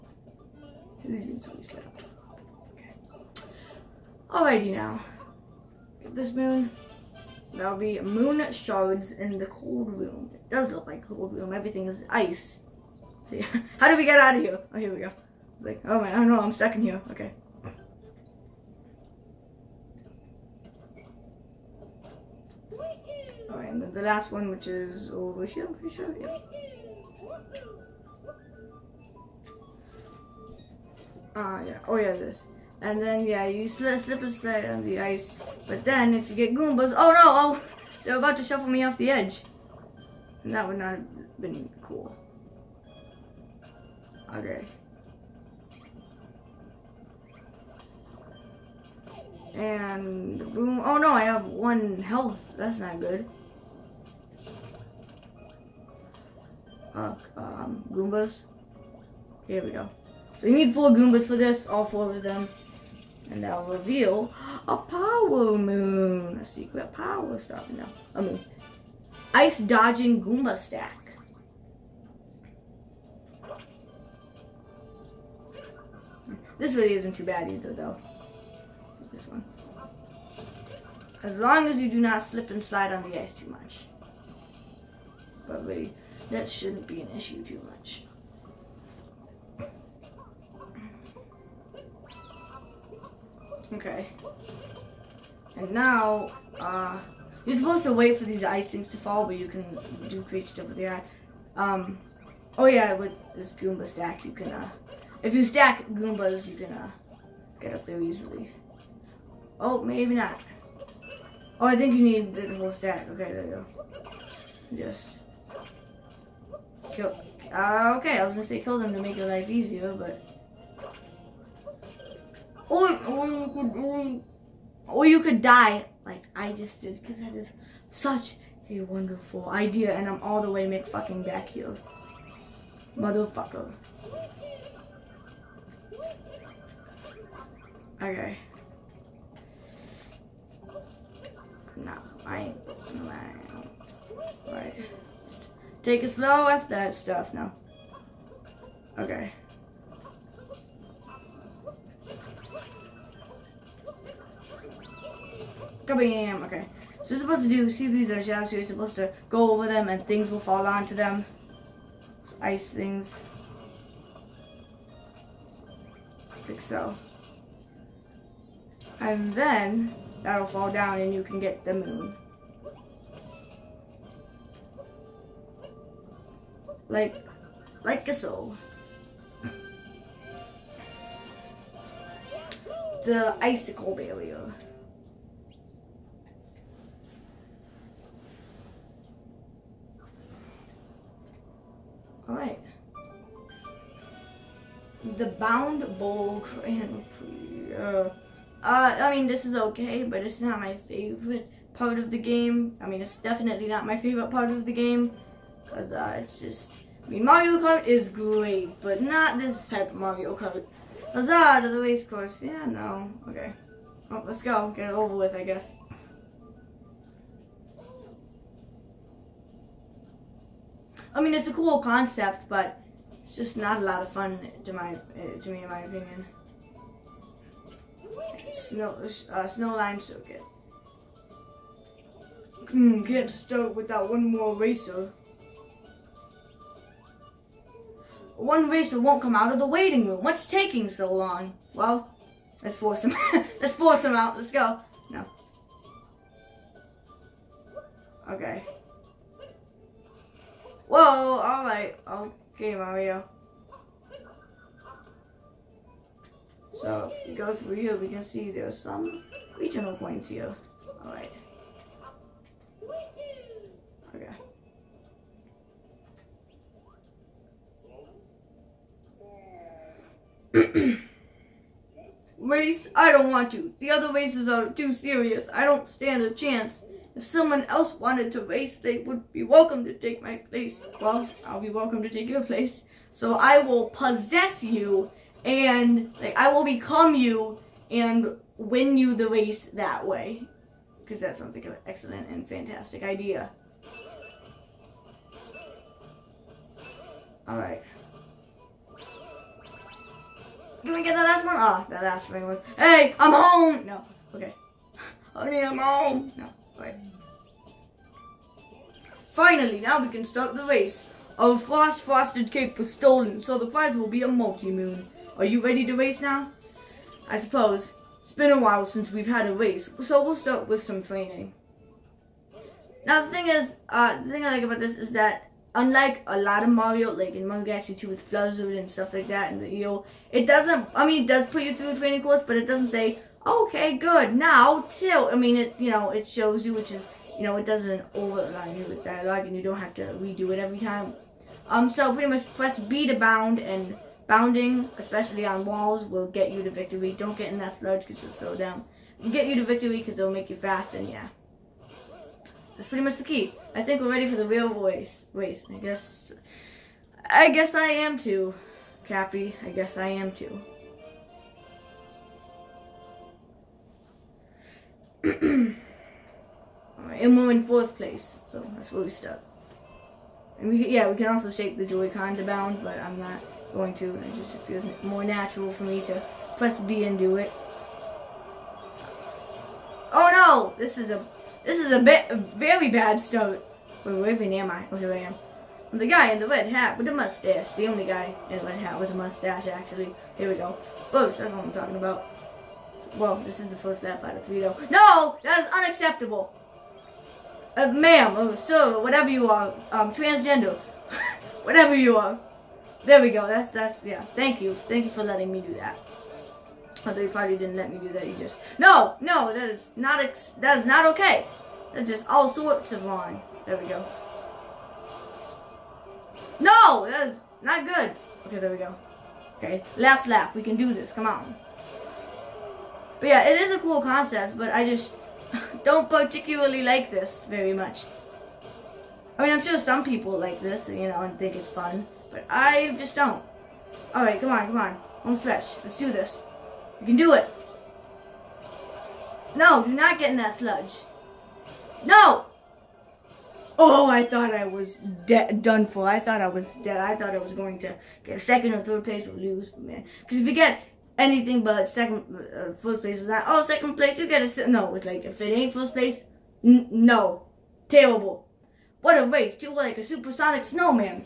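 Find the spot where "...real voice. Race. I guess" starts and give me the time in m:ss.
5:54.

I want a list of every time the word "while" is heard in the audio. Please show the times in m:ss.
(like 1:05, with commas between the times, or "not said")
5:18.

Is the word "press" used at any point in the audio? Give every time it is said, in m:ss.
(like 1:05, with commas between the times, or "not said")
5:42, 6:16.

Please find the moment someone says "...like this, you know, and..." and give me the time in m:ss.
7:10.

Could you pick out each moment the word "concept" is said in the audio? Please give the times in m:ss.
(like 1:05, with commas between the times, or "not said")
3:41, 7:04.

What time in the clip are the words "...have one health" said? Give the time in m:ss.
0:51.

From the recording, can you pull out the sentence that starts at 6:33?
Well, this is the first lap out of three, though.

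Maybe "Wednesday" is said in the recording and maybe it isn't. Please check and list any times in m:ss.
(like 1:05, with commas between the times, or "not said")
not said.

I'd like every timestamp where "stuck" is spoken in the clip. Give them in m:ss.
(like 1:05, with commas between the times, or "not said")
0:16, 6:09.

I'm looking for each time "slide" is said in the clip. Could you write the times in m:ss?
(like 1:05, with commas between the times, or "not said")
0:34, 1:22.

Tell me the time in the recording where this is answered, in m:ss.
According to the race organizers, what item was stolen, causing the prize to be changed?
5:11.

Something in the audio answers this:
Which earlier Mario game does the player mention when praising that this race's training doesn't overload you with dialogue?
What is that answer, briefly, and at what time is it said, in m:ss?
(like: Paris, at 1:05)
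Mario Galaxy 2, at 5:27.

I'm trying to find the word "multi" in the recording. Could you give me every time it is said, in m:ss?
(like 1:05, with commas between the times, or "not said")
5:14.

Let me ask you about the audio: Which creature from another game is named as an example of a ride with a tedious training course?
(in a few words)
Fluzzard.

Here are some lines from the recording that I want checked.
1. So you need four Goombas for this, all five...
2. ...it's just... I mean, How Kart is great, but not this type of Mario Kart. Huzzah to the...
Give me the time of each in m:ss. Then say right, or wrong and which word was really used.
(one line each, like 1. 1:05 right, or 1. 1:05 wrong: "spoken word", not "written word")
1. 1:00 wrong: "four", not "five"
2. 3:26 wrong: "Mario", not "How".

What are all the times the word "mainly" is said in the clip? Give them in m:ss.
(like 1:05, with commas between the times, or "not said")
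not said.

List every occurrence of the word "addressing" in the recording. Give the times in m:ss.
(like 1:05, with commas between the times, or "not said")
not said.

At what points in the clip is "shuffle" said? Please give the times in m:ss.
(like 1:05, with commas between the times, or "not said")
0:38.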